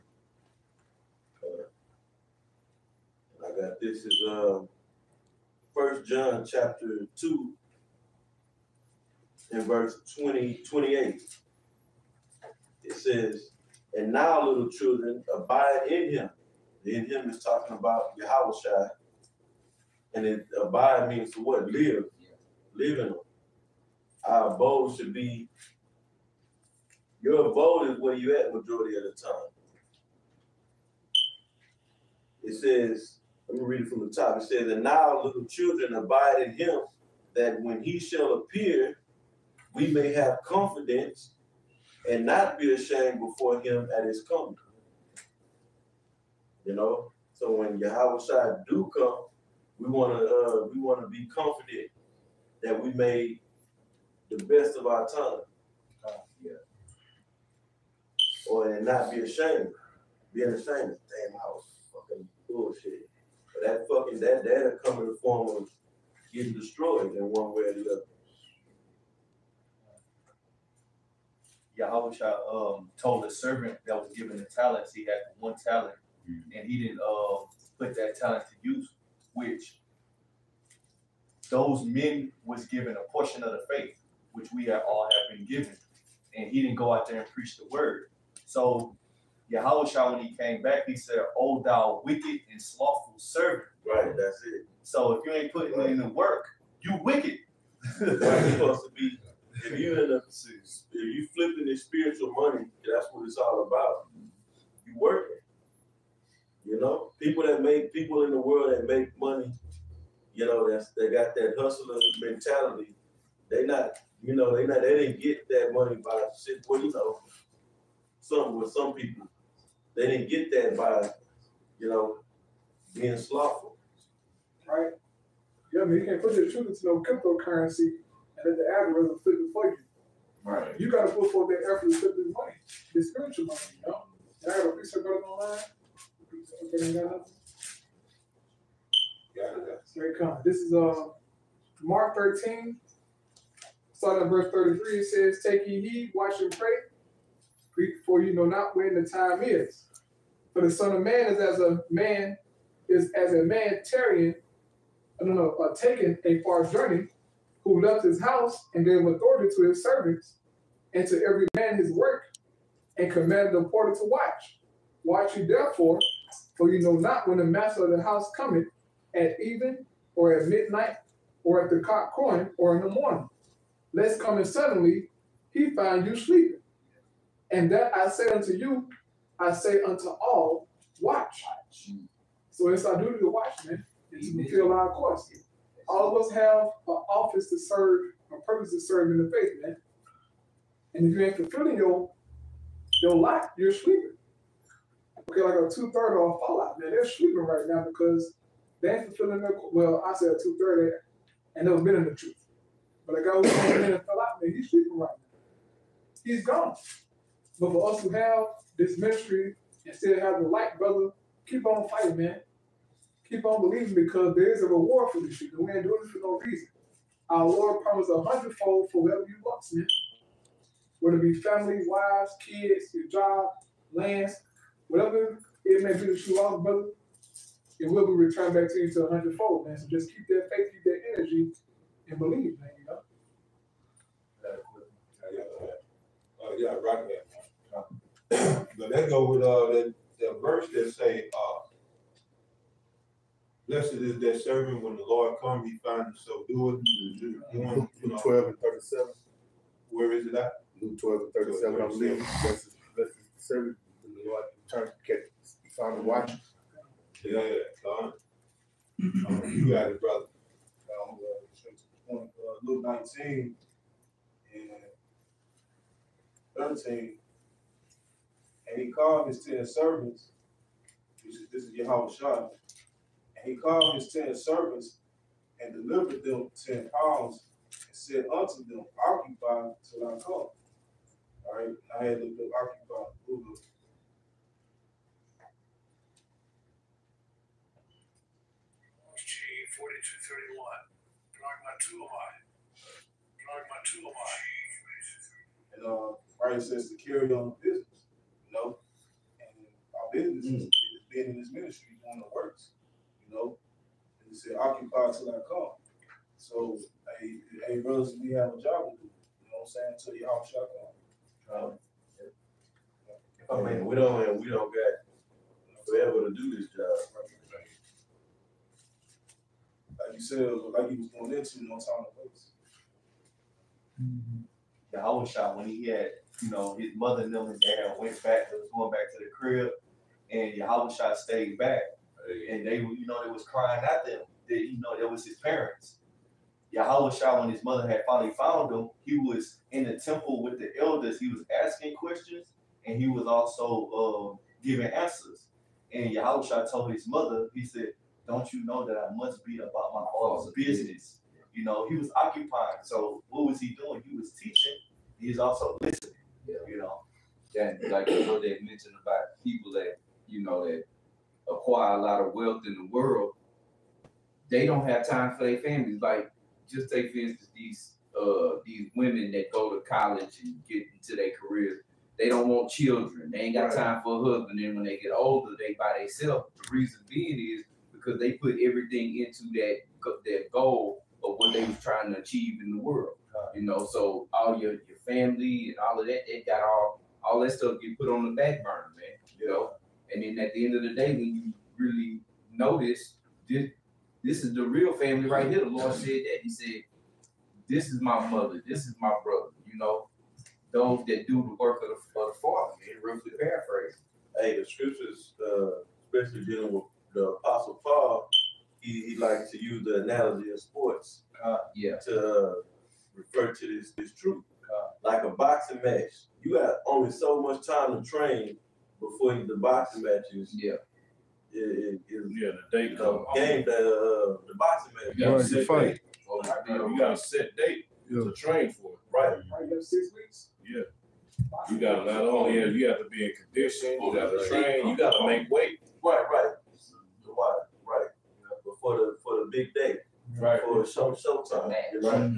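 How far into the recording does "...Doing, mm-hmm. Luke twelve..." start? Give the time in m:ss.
4:06.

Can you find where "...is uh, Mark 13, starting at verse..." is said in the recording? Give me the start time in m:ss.
2:20.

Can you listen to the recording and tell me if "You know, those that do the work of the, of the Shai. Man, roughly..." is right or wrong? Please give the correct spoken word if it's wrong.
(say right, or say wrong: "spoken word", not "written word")
wrong: "Father", not "Shai".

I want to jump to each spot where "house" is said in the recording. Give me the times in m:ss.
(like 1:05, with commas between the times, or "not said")
2:38, 2:48.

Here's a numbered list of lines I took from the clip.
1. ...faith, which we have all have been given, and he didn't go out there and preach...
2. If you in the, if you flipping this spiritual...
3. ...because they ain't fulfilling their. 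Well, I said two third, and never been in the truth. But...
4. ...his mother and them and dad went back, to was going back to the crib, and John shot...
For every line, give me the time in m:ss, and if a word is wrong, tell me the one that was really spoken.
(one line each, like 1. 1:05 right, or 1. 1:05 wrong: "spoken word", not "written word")
1. 1:23 right
2. 1:39 right
3. 3:17 right
4. 5:26 wrong: "Yahweh", not "John".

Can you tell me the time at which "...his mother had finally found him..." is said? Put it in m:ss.
5:37.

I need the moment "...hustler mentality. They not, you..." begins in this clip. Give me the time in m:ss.
1:51.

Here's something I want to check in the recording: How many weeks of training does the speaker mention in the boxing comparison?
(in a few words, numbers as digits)
6.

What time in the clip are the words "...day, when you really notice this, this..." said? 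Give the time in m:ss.
6:30.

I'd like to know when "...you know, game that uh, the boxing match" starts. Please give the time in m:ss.
7:02.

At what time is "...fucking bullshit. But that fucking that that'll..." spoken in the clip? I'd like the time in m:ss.
1:01.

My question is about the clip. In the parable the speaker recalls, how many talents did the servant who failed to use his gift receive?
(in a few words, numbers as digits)
1.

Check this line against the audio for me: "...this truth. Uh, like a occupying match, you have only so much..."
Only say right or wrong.
wrong.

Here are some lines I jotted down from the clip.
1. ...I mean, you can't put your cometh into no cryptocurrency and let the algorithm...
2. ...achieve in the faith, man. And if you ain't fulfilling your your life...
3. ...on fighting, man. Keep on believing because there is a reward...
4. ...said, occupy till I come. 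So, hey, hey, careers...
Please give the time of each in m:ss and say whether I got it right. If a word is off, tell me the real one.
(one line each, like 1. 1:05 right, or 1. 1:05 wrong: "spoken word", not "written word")
1. 2:05 wrong: "truth", not "cometh"
2. 3:08 wrong: "serve", not "achieve"
3. 3:31 right
4. 5:04 wrong: "brothers", not "careers".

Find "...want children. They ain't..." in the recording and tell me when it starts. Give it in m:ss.
6:12.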